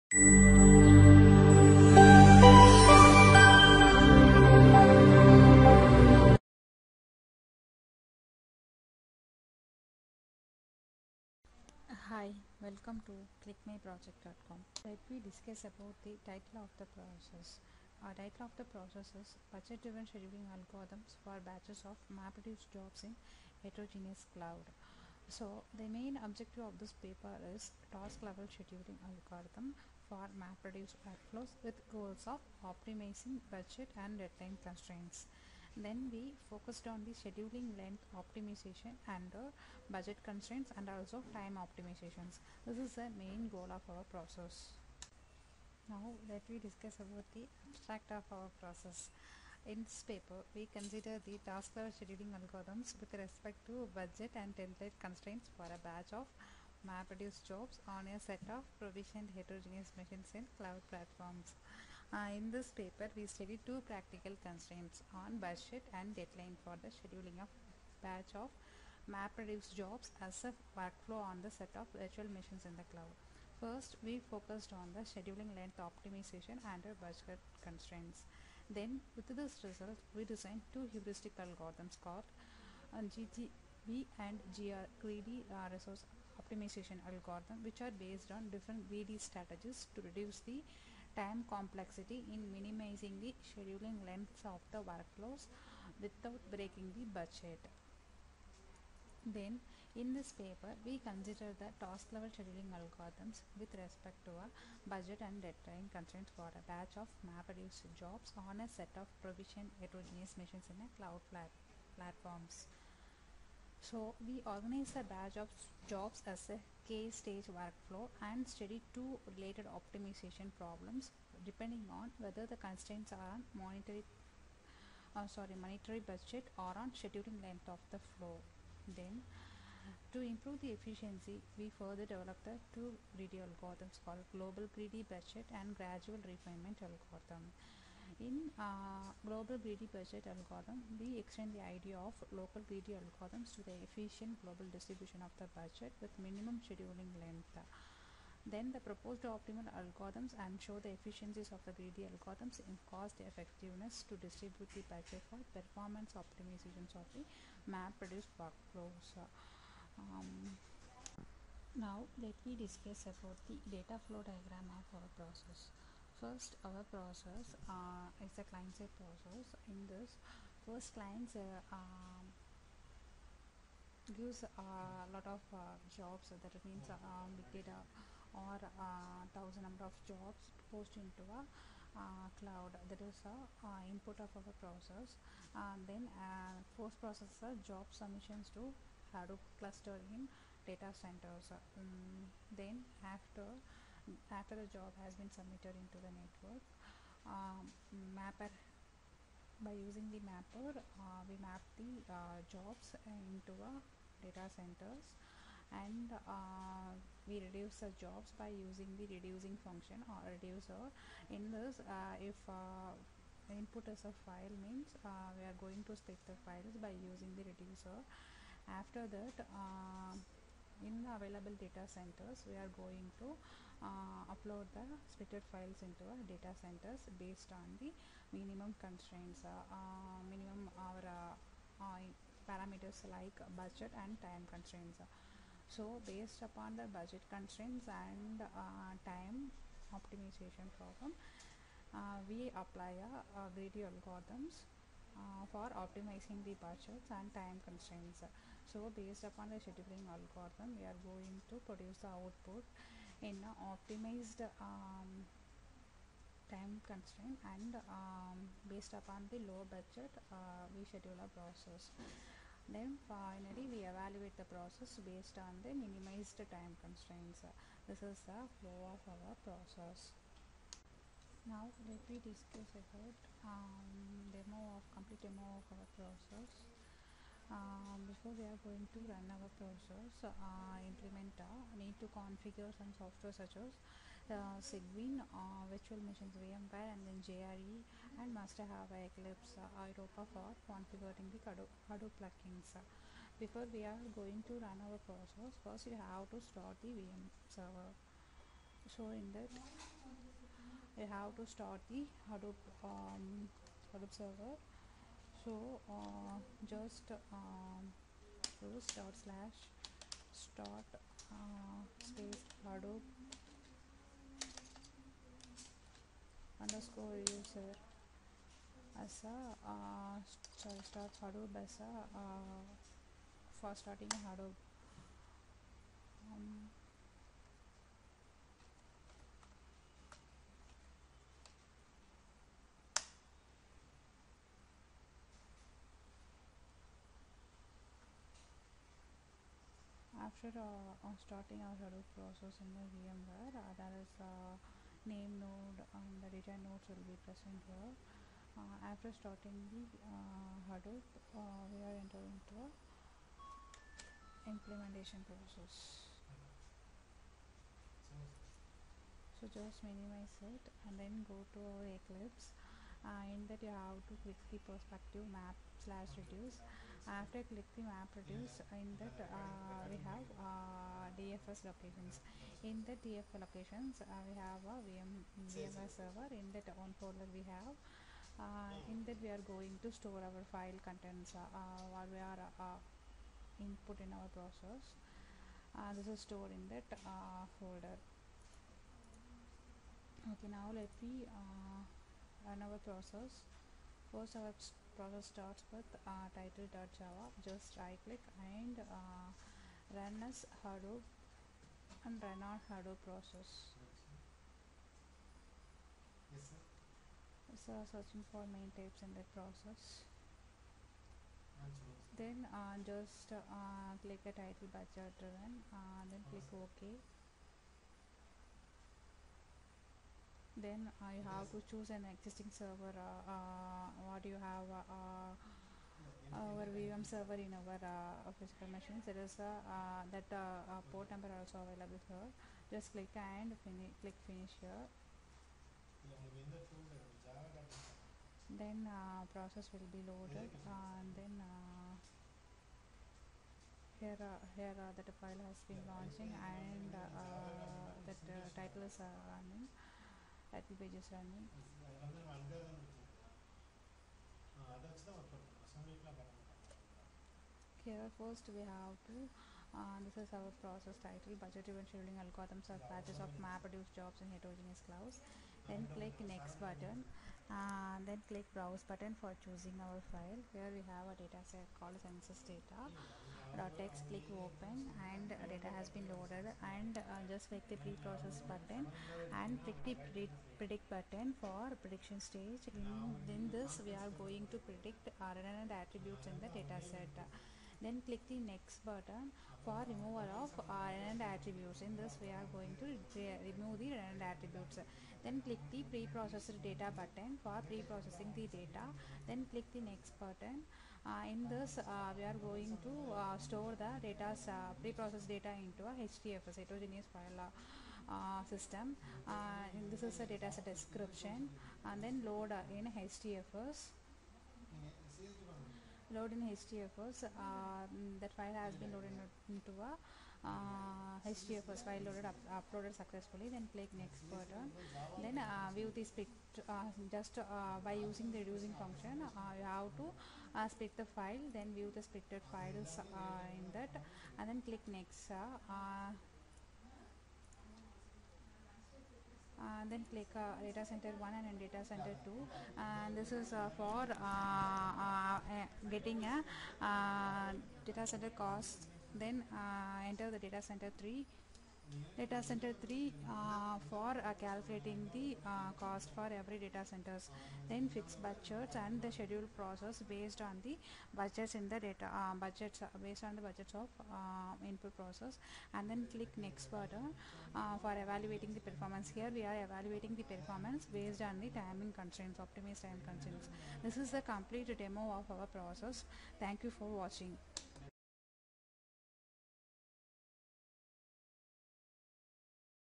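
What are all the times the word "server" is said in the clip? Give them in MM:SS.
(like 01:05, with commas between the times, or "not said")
04:57, 05:04, 06:15, 07:02, 07:07.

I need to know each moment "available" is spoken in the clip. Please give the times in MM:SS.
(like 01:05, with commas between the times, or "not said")
03:41, 07:11.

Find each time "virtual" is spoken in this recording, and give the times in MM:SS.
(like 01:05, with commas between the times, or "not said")
01:11, 04:45.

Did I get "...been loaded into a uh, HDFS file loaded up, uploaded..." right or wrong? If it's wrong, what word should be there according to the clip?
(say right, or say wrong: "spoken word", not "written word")
right.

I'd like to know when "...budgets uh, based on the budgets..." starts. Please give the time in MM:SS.
09:22.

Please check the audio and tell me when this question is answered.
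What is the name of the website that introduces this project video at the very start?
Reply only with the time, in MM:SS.
00:13.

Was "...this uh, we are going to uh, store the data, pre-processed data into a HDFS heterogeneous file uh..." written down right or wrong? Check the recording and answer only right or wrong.
right.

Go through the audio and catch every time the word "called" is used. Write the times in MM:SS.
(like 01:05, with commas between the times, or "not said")
01:22, 02:14, 07:51.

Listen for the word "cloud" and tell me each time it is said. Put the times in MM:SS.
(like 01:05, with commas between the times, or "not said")
00:24, 01:00, 01:12, 01:50, 03:02, 07:44.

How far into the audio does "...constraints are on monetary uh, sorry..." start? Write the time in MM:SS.
02:02.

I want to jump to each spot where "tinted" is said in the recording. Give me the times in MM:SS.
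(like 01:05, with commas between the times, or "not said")
not said.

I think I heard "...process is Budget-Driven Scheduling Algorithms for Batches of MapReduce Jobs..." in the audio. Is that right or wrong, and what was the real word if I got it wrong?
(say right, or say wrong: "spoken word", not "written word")
right.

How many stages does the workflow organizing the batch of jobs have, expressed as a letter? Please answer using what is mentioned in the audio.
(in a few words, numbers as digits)
K stage.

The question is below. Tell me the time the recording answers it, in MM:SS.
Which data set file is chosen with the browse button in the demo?
07:52.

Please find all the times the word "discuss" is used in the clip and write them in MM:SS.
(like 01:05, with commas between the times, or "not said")
00:15, 00:46, 02:42, 04:32.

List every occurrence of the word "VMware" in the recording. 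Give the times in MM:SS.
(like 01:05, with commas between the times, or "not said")
04:46, 05:42.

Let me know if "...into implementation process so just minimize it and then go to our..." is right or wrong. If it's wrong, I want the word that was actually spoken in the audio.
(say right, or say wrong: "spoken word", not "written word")
right.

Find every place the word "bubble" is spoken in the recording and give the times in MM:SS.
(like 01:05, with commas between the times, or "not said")
not said.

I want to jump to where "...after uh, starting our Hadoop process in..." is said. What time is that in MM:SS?
05:40.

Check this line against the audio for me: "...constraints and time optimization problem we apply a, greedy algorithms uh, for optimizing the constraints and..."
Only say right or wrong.
wrong.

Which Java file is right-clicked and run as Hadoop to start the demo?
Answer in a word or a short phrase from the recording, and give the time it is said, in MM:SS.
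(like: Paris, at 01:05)
title.java, at 06:36.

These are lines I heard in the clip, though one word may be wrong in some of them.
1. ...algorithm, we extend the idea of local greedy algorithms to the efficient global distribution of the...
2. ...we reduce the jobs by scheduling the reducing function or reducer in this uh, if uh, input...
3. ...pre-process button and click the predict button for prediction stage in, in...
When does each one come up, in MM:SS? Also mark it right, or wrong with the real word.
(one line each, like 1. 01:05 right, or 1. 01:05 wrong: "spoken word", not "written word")
1. 02:20 right
2. 03:27 wrong: "using", not "scheduling"
3. 07:57 right.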